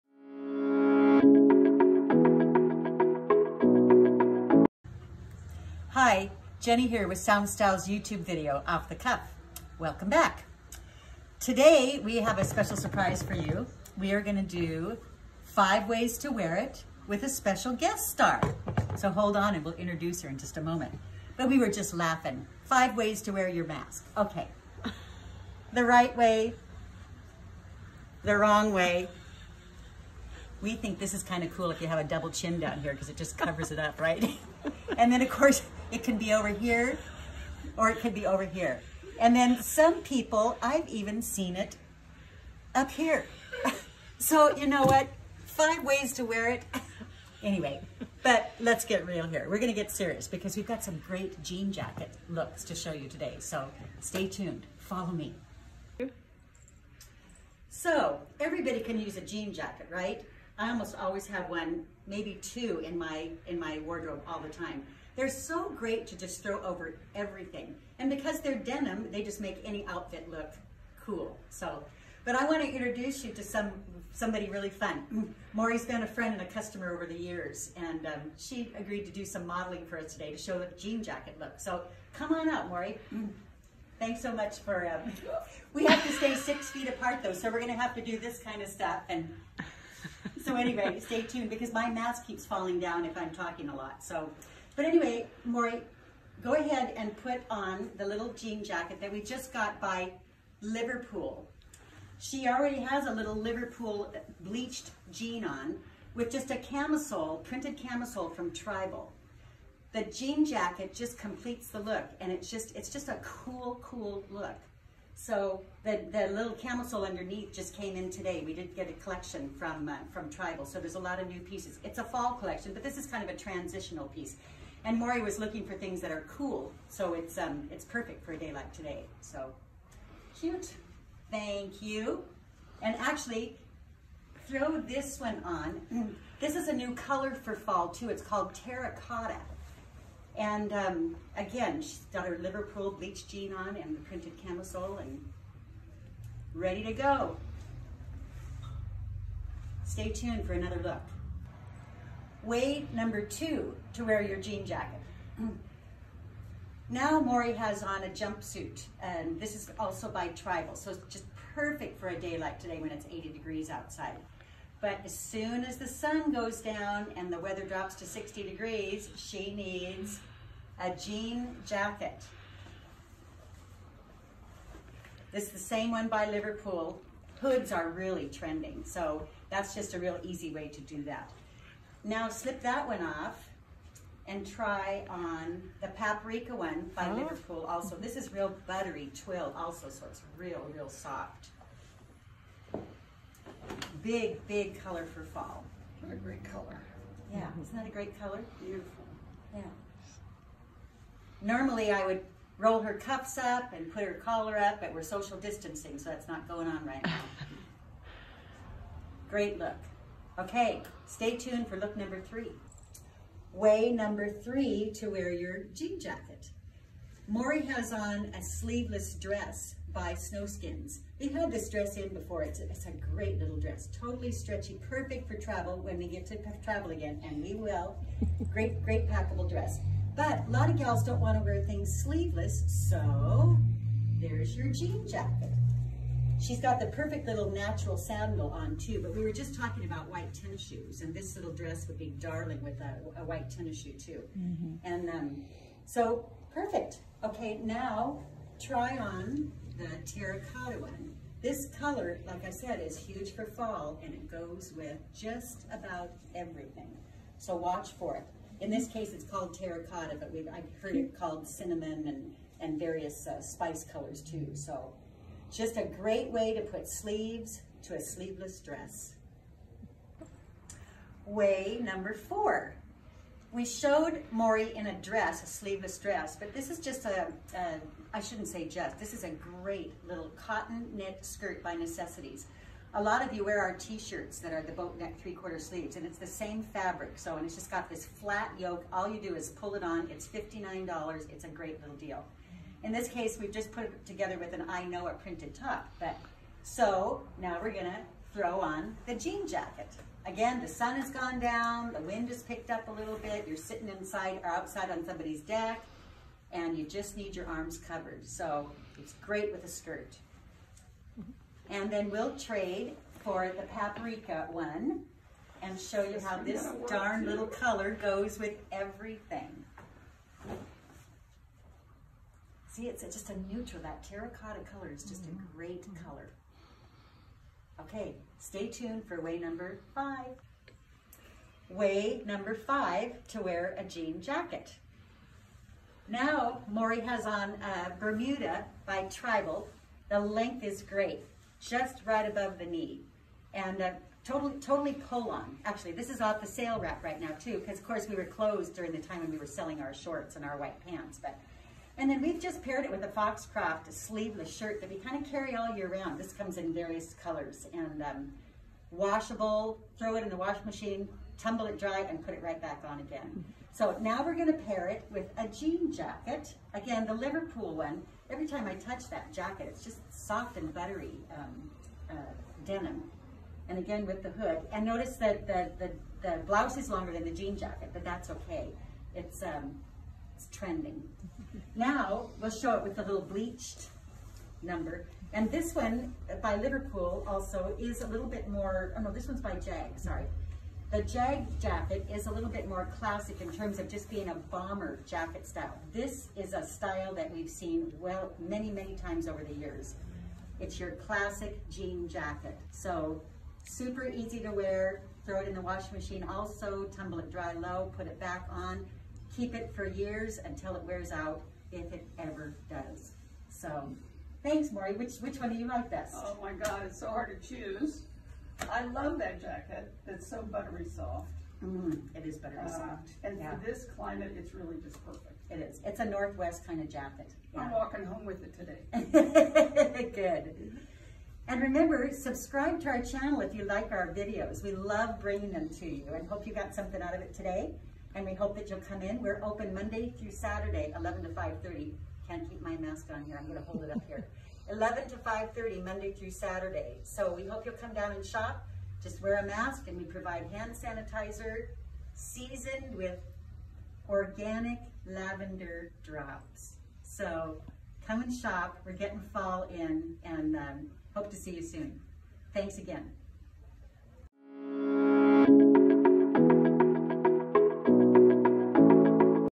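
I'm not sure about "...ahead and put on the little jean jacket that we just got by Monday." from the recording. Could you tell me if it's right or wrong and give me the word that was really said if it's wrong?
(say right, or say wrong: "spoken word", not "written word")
wrong: "Liverpool", not "Monday".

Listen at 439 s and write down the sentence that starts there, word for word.
We're open Monday through Saturday, 11 to 5.30.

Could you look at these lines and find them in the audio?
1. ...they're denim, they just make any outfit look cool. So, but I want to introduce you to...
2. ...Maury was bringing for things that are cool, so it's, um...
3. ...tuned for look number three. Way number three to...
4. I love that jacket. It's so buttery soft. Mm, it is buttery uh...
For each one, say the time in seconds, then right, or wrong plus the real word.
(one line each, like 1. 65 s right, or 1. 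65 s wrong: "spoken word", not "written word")
1. 68 s right
2. 124 s wrong: "looking", not "bringing"
3. 211 s right
4. 418 s right.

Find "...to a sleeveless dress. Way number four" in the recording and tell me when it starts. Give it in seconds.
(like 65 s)
267 s.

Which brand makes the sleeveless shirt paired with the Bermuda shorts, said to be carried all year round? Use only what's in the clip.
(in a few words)
Foxcroft.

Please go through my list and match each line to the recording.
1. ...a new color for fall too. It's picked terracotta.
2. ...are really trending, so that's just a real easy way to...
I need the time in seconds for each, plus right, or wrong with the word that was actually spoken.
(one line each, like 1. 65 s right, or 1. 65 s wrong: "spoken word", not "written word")
1. 136 s wrong: "called", not "picked"
2. 177 s right.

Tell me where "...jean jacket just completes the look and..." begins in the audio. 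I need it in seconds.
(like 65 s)
110 s.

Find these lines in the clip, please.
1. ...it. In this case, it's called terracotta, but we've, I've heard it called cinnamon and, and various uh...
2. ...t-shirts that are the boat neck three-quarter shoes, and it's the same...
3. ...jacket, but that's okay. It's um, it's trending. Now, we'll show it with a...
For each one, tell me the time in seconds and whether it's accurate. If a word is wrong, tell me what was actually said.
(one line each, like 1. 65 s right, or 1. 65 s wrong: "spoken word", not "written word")
1. 258 s right
2. 283 s wrong: "sleeves", not "shoes"
3. 377 s right.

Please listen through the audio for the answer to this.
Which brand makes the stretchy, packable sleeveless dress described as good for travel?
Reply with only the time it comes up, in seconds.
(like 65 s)
220 s.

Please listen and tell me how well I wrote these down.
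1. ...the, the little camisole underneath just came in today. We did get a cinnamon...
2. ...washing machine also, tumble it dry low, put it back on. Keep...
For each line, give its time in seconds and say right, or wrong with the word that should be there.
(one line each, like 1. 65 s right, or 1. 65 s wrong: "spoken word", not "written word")
1. 115 s wrong: "collection", not "cinnamon"
2. 405 s right.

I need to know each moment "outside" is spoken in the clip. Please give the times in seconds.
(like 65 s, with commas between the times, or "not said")
163 s, 304 s.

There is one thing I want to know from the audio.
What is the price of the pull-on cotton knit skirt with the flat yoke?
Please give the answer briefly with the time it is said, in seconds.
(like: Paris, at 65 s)
$59, at 290 s.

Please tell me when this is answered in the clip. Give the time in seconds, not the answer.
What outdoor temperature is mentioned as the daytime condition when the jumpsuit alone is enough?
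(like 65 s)
163 s.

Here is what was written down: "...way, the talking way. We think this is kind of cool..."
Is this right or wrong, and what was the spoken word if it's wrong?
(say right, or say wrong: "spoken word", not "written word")
wrong: "wrong", not "talking".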